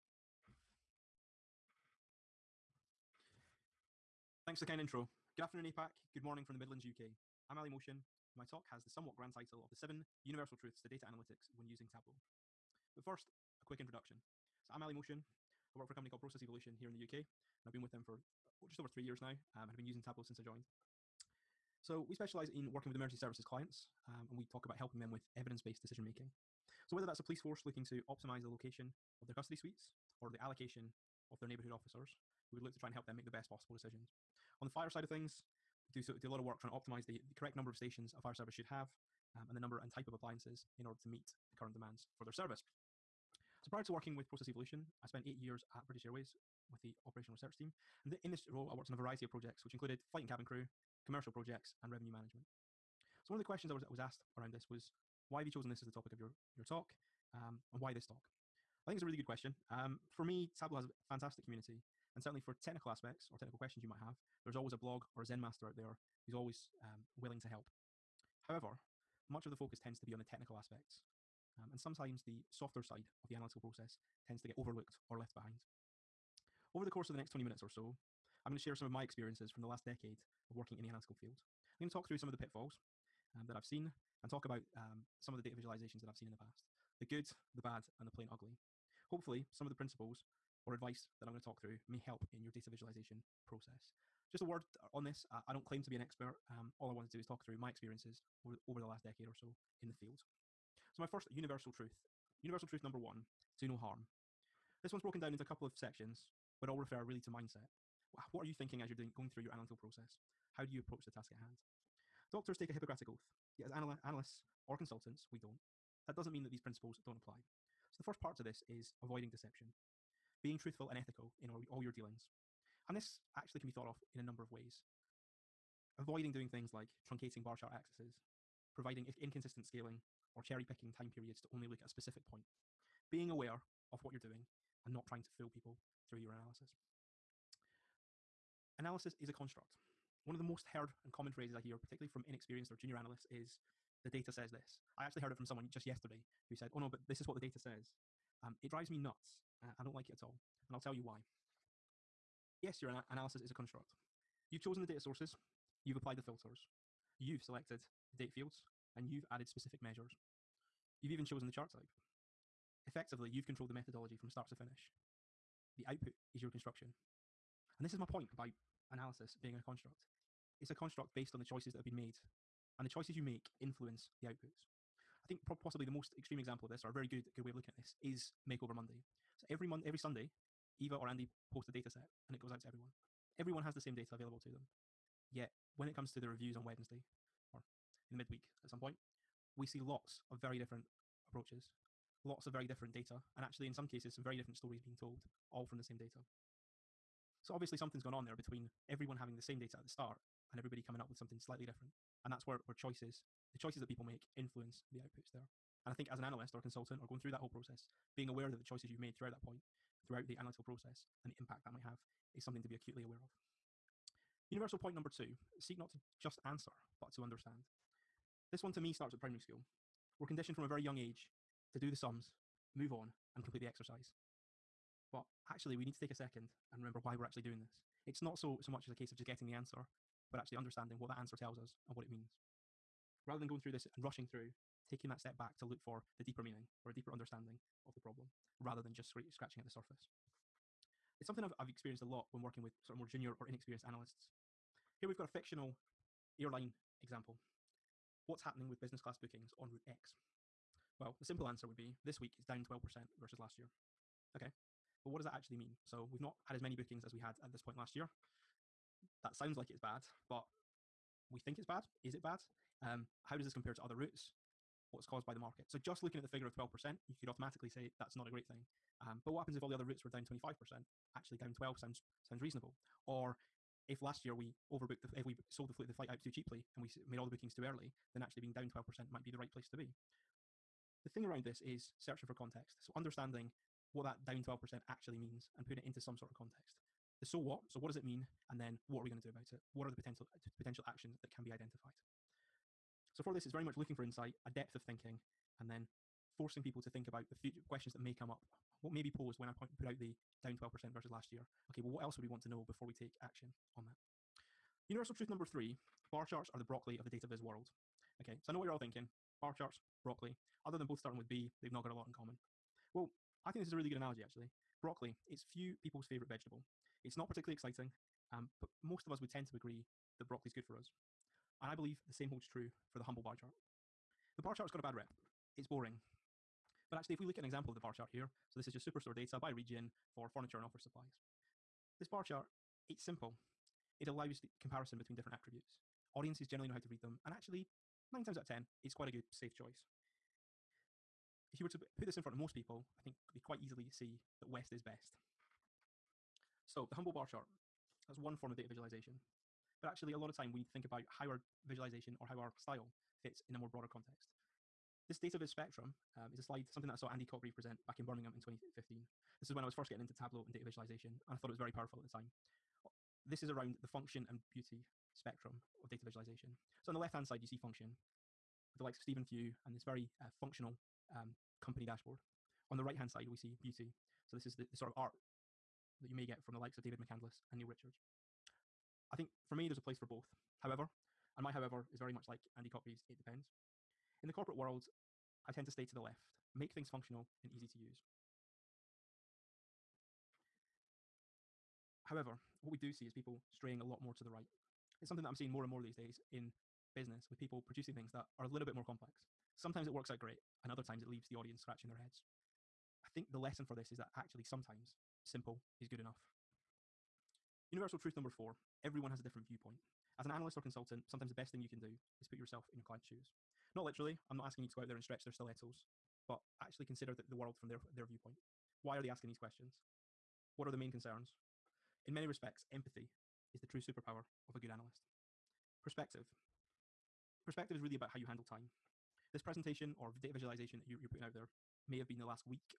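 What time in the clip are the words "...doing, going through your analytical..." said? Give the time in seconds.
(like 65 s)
108 s.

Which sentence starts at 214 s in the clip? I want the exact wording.
Universal point number two seek not to just answer, but to understand.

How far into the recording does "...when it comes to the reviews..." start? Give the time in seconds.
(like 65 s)
185 s.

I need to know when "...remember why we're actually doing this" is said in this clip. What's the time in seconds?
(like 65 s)
226 s.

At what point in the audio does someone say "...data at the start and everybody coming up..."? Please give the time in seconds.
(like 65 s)
199 s.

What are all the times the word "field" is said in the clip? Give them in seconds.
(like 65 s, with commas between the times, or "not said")
81 s, 99 s, 158 s.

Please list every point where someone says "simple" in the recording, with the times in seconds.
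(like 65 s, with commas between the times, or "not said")
251 s, 333 s, 405 s.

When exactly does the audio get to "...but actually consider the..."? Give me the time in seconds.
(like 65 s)
416 s.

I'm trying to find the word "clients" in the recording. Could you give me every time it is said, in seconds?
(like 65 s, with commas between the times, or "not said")
23 s, 412 s.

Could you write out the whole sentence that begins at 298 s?
What may be posed when I point, put out the down 12% versus last year?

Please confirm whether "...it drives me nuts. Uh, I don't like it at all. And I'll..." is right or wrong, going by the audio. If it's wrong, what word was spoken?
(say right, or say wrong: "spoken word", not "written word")
right.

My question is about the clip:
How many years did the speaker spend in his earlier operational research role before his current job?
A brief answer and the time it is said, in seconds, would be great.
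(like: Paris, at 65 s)
8, at 45 s.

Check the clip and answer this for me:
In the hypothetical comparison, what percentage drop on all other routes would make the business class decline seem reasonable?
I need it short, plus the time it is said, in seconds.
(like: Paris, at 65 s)
25%, at 270 s.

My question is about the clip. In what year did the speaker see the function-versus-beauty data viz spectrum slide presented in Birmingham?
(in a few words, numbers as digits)
2015.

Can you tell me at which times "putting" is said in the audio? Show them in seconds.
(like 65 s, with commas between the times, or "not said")
285 s, 431 s.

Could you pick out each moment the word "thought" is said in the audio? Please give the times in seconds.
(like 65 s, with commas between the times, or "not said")
123 s, 361 s.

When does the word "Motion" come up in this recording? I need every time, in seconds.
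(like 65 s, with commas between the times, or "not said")
7 s, 14 s.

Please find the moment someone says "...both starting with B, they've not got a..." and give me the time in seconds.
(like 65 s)
310 s.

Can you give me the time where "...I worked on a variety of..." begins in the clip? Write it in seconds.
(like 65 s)
48 s.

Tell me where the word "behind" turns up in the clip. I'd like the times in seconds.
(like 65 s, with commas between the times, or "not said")
75 s.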